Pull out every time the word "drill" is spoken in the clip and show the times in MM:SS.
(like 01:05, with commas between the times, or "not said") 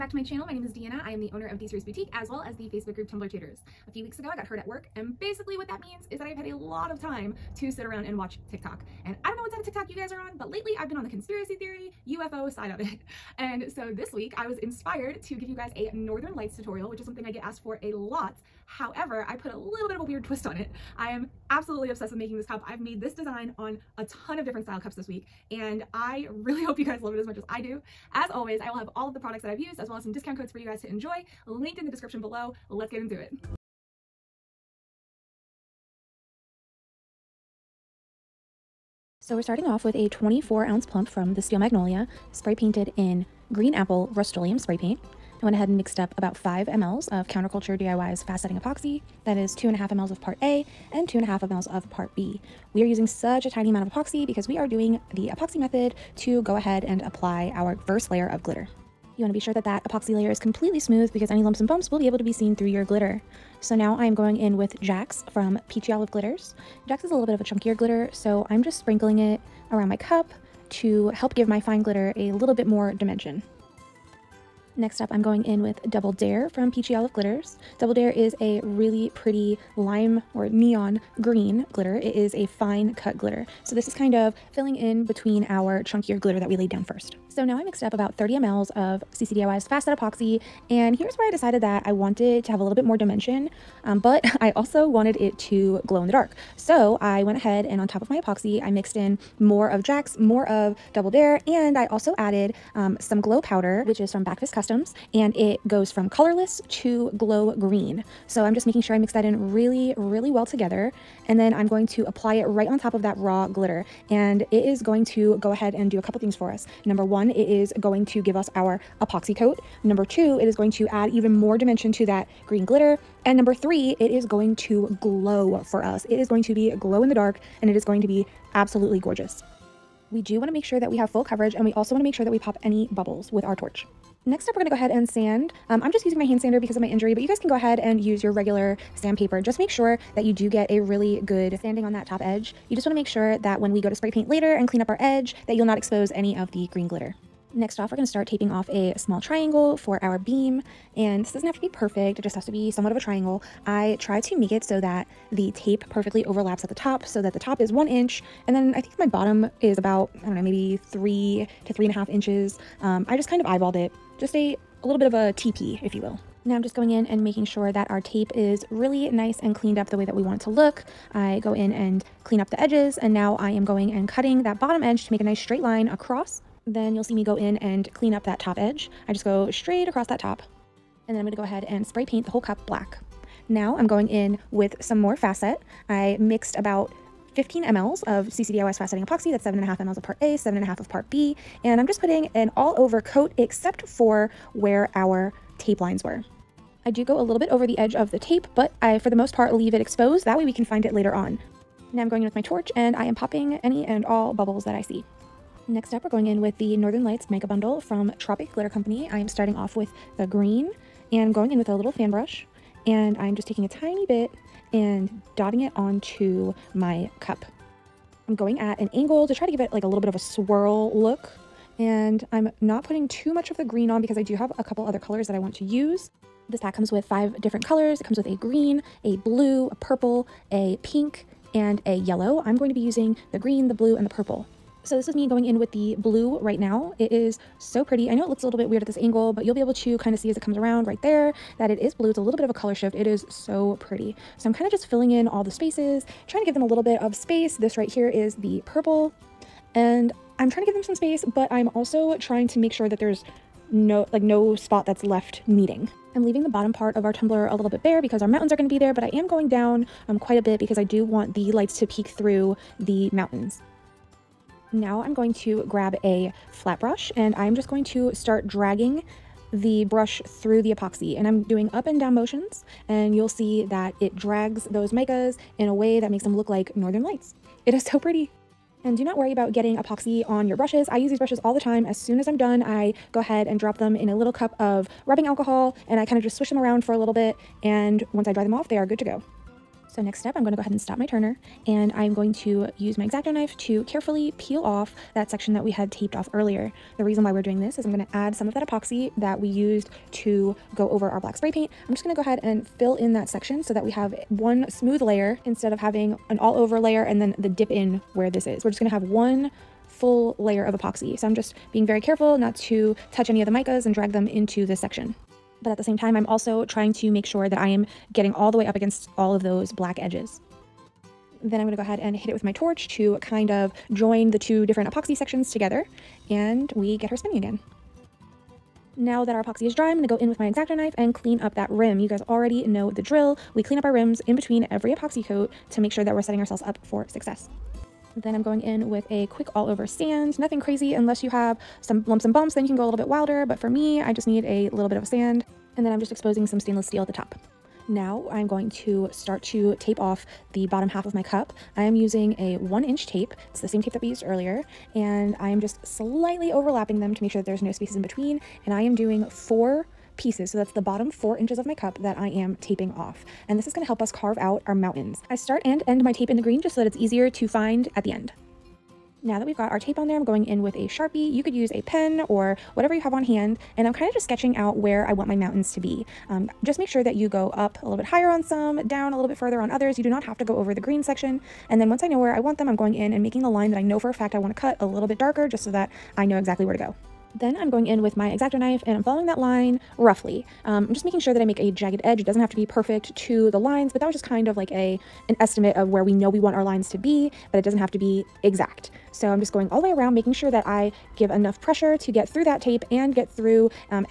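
05:33.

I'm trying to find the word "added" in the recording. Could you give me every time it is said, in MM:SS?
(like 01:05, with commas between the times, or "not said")
01:42.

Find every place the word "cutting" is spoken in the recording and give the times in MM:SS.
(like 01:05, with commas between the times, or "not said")
02:54.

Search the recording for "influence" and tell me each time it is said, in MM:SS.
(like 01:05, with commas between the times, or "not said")
not said.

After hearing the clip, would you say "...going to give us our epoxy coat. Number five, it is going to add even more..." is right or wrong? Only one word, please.
wrong.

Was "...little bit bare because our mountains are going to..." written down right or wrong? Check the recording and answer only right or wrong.
right.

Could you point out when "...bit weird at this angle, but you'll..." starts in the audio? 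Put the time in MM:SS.
03:58.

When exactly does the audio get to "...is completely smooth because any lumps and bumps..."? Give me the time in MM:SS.
01:00.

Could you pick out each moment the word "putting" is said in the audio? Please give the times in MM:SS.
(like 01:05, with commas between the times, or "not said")
03:11, 03:42.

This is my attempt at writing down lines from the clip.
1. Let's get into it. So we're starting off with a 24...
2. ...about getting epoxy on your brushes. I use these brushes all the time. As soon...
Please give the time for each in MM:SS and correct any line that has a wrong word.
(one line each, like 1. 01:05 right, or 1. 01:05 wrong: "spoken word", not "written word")
1. 00:32 right
2. 04:39 right.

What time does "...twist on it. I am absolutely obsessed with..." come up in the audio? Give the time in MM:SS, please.
00:20.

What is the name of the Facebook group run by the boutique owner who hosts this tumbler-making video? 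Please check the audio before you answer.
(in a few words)
Tumbler Tutors.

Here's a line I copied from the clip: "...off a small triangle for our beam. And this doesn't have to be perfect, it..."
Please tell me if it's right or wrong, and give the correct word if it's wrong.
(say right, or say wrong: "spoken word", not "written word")
right.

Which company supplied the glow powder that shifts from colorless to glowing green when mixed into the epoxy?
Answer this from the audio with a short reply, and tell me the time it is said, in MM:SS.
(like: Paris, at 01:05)
Backfist Customs, at 01:44.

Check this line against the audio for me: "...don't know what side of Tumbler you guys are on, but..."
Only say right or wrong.
wrong.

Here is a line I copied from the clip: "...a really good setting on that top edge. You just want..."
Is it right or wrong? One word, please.
wrong.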